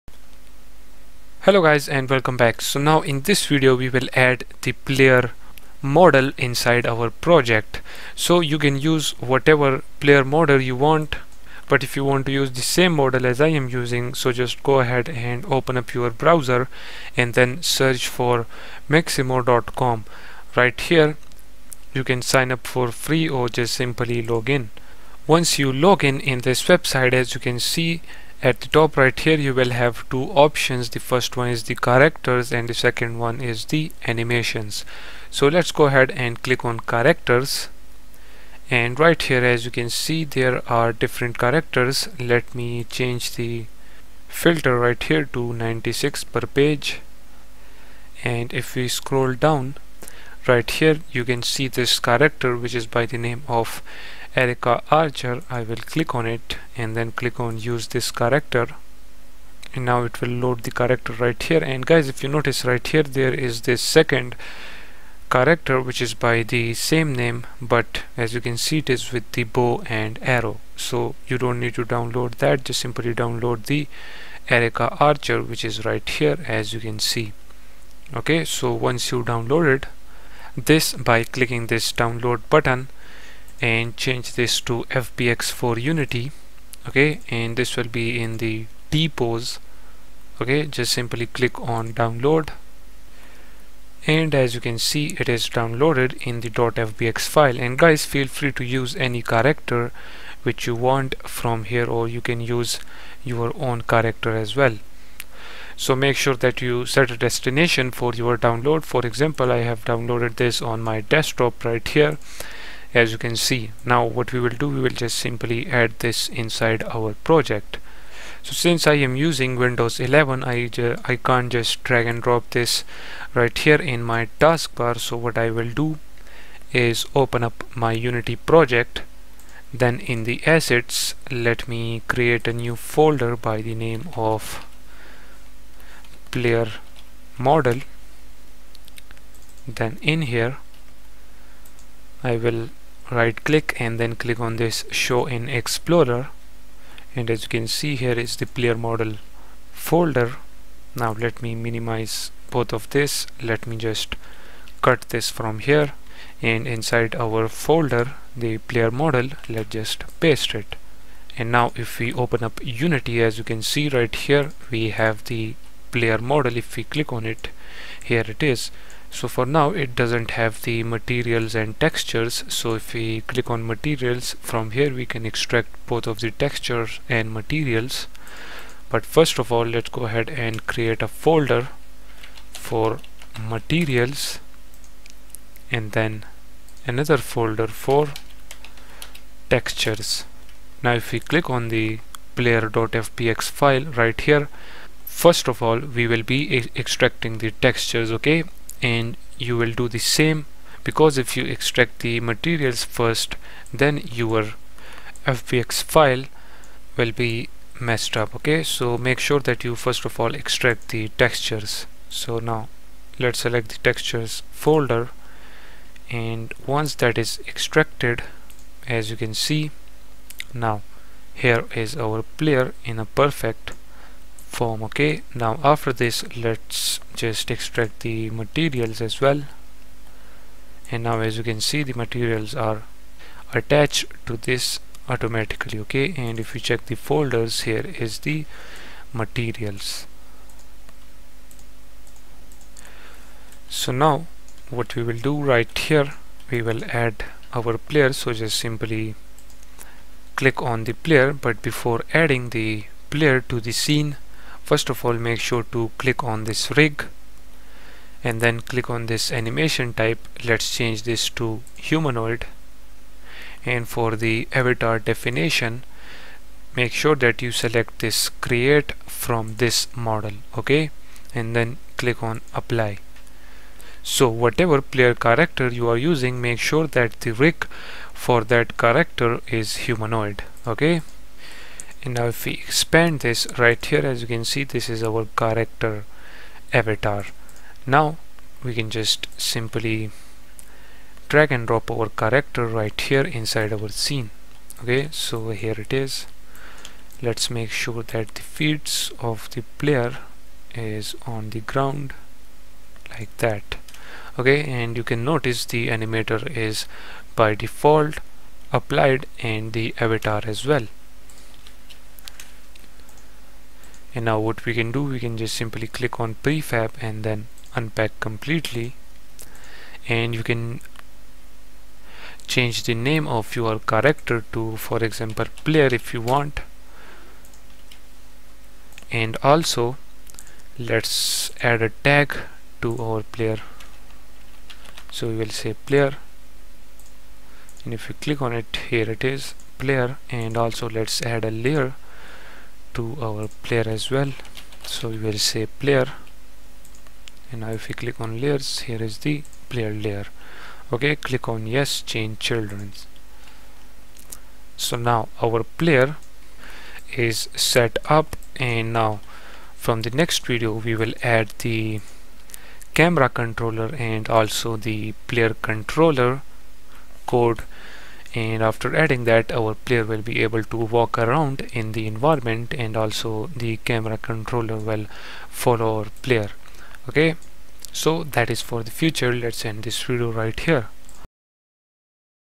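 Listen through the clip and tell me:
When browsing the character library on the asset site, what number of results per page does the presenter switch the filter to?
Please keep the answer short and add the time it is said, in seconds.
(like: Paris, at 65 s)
96, at 45 s.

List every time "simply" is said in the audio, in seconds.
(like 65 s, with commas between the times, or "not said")
23 s, 72 s, 90 s, 115 s, 248 s, 289 s, 315 s.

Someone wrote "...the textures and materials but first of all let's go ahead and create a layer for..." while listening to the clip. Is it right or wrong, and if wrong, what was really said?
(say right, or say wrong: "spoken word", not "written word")
wrong: "folder", not "layer".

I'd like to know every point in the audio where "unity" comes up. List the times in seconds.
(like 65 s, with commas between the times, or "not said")
85 s, 127 s, 162 s.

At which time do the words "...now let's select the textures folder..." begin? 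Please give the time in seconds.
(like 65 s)
212 s.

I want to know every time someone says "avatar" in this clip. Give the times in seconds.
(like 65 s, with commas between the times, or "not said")
264 s, 286 s, 309 s.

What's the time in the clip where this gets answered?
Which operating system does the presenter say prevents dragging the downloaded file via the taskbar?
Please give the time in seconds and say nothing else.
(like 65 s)
119 s.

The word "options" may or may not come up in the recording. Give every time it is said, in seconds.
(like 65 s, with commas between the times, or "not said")
30 s.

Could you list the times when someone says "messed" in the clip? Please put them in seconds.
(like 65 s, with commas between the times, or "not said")
207 s.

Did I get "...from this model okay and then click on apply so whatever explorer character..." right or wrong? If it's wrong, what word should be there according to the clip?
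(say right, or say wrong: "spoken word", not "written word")
wrong: "player", not "explorer".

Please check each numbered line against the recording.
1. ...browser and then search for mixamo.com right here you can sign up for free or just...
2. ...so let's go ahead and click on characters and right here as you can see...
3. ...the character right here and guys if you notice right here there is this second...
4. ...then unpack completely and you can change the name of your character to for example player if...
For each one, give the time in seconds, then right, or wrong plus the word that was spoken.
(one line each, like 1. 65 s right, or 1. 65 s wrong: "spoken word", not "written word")
1. 16 s right
2. 35 s right
3. 60 s right
4. 317 s right.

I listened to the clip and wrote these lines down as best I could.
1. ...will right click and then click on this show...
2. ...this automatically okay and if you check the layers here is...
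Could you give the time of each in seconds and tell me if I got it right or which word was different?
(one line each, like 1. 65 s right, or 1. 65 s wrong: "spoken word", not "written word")
1. 142 s right
2. 234 s wrong: "folders", not "layers".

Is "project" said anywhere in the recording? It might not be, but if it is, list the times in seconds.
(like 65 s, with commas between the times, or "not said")
7 s, 117 s, 128 s.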